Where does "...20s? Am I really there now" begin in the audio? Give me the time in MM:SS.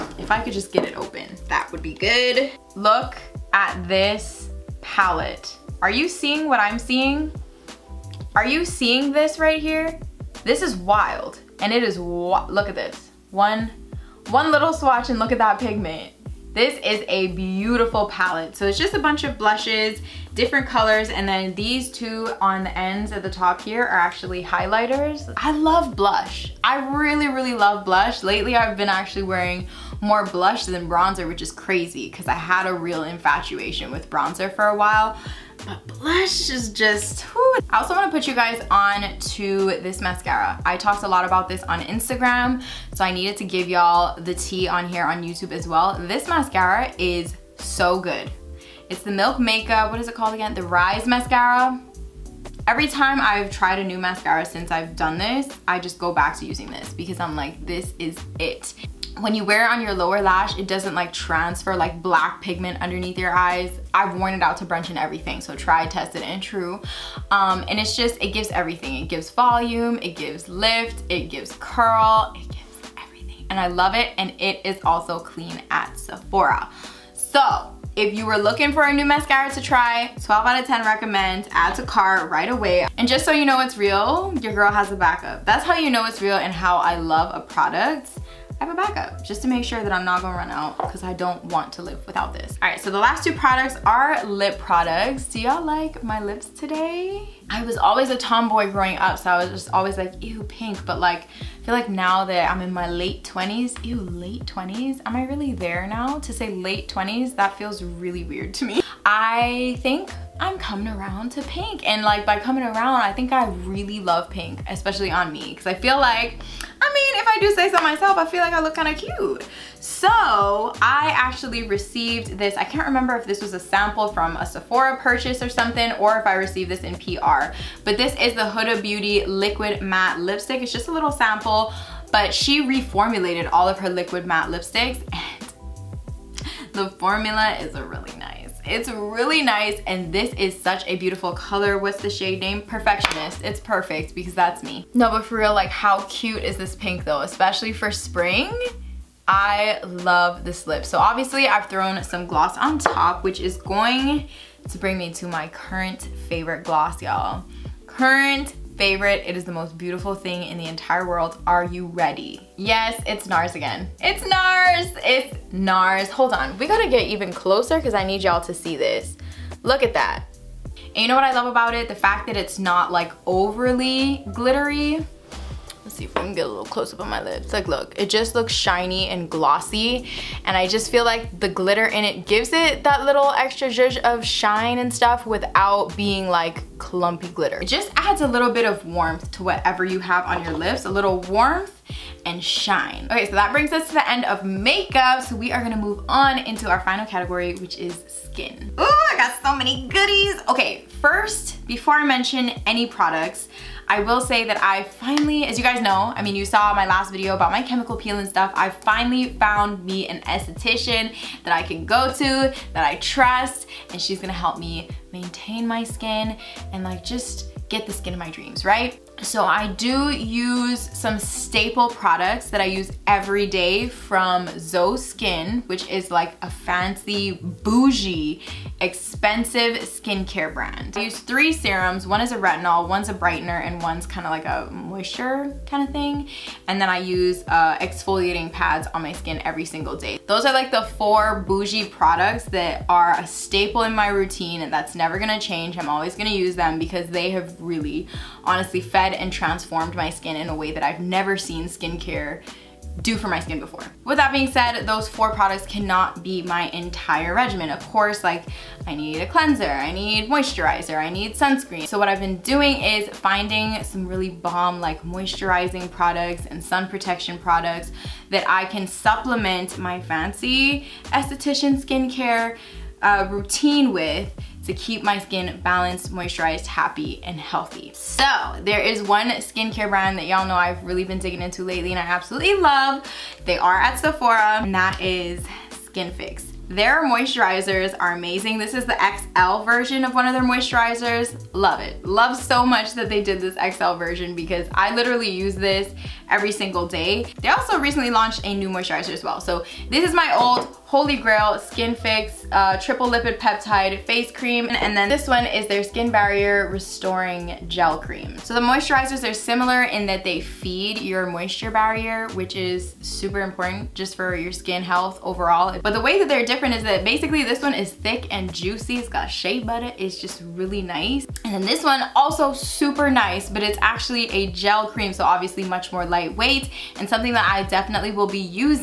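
01:44.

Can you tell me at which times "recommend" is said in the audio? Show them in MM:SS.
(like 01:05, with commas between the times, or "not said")
01:20.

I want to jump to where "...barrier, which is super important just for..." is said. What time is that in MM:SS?
05:11.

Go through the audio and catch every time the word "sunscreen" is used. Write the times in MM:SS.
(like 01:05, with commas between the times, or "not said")
04:21.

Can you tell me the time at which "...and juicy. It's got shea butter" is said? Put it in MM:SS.
05:18.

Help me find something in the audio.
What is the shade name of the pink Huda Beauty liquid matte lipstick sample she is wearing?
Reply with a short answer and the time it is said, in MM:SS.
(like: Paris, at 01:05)
Perfectionist, at 02:22.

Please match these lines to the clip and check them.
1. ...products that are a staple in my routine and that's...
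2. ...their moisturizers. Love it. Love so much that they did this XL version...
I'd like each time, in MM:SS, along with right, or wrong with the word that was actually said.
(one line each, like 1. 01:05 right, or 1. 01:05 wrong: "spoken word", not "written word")
1. 04:01 right
2. 04:50 right.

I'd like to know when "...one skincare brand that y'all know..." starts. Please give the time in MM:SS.
04:39.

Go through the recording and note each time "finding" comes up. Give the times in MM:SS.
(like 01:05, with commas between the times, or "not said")
04:23.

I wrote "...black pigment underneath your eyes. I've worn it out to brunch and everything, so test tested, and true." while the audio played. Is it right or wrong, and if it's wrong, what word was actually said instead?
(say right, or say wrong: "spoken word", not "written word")
right.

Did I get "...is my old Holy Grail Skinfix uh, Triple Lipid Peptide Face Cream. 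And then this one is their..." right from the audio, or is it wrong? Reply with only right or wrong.
right.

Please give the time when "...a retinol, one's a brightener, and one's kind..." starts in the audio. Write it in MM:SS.
03:52.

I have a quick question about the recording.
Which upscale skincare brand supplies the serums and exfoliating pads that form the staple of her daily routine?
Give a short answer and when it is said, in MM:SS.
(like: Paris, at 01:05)
ZO Skin, at 03:44.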